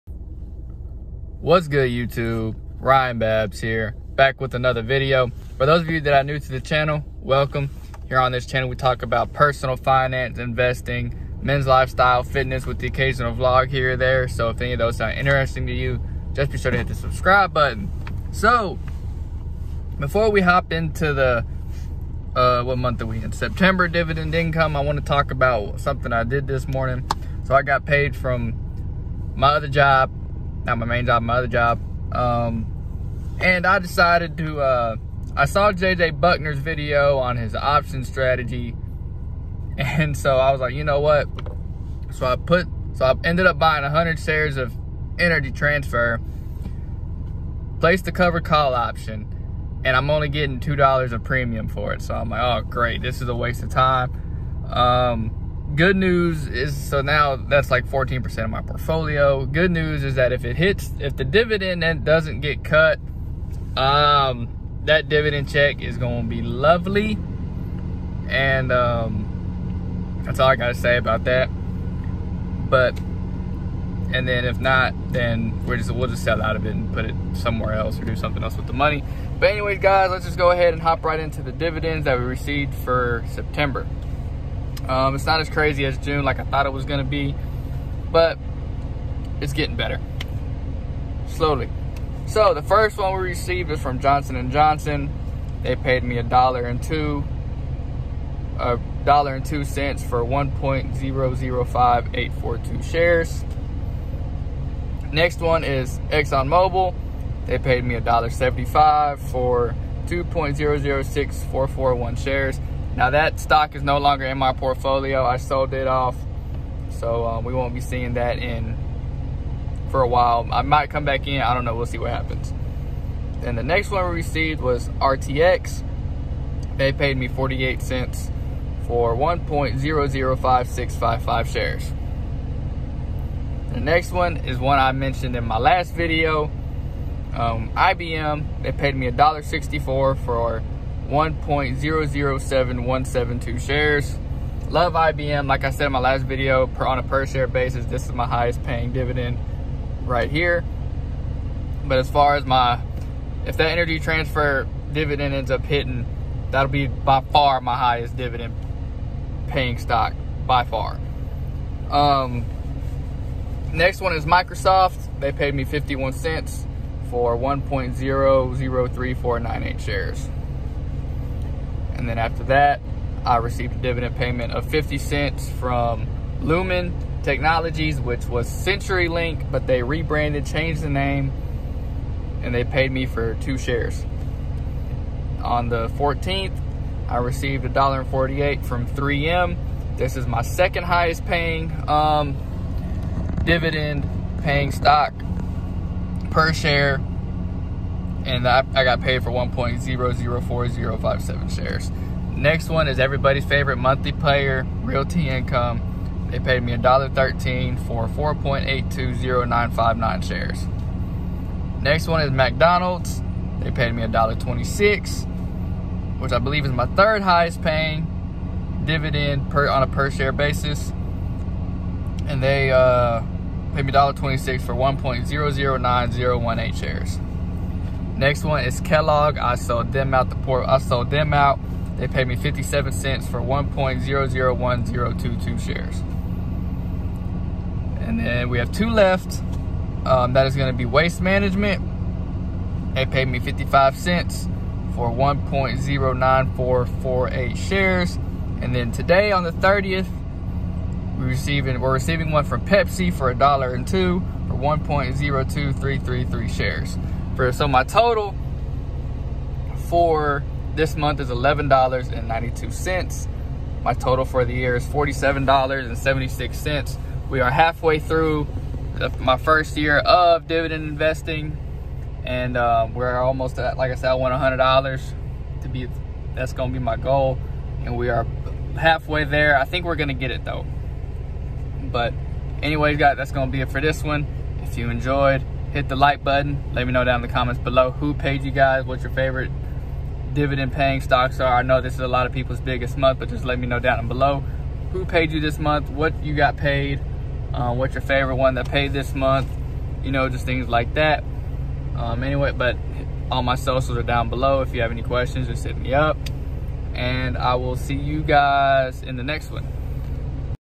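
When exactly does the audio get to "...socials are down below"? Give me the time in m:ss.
5:03.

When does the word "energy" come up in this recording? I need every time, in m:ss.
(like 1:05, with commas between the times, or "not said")
0:45, 2:33.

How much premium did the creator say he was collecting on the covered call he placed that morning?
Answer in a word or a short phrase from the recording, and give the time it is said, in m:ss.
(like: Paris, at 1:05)
$2, at 0:50.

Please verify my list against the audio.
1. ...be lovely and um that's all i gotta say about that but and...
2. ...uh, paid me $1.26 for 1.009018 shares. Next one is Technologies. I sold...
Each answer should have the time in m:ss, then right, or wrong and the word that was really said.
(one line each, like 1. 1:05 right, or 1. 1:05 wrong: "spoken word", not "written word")
1. 1:06 right
2. 3:42 wrong: "Kellogg", not "Technologies".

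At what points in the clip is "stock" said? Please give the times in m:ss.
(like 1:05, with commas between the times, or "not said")
1:53, 2:39, 3:14, 4:51.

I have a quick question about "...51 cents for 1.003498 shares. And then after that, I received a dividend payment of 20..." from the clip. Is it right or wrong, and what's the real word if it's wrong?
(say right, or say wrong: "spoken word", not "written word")
wrong: "50", not "20".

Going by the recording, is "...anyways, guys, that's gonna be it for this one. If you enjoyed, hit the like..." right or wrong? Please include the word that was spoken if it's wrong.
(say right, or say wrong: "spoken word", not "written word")
right.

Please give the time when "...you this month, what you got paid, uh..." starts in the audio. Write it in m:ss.
4:55.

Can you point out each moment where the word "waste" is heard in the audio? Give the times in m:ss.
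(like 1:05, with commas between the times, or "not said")
0:53, 4:00.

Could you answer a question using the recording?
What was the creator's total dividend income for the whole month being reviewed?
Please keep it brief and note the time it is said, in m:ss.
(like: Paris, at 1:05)
$11.92, at 4:21.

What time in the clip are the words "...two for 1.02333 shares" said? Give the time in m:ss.
4:13.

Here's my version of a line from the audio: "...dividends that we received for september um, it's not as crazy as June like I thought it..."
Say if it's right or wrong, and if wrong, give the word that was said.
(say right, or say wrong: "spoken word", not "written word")
right.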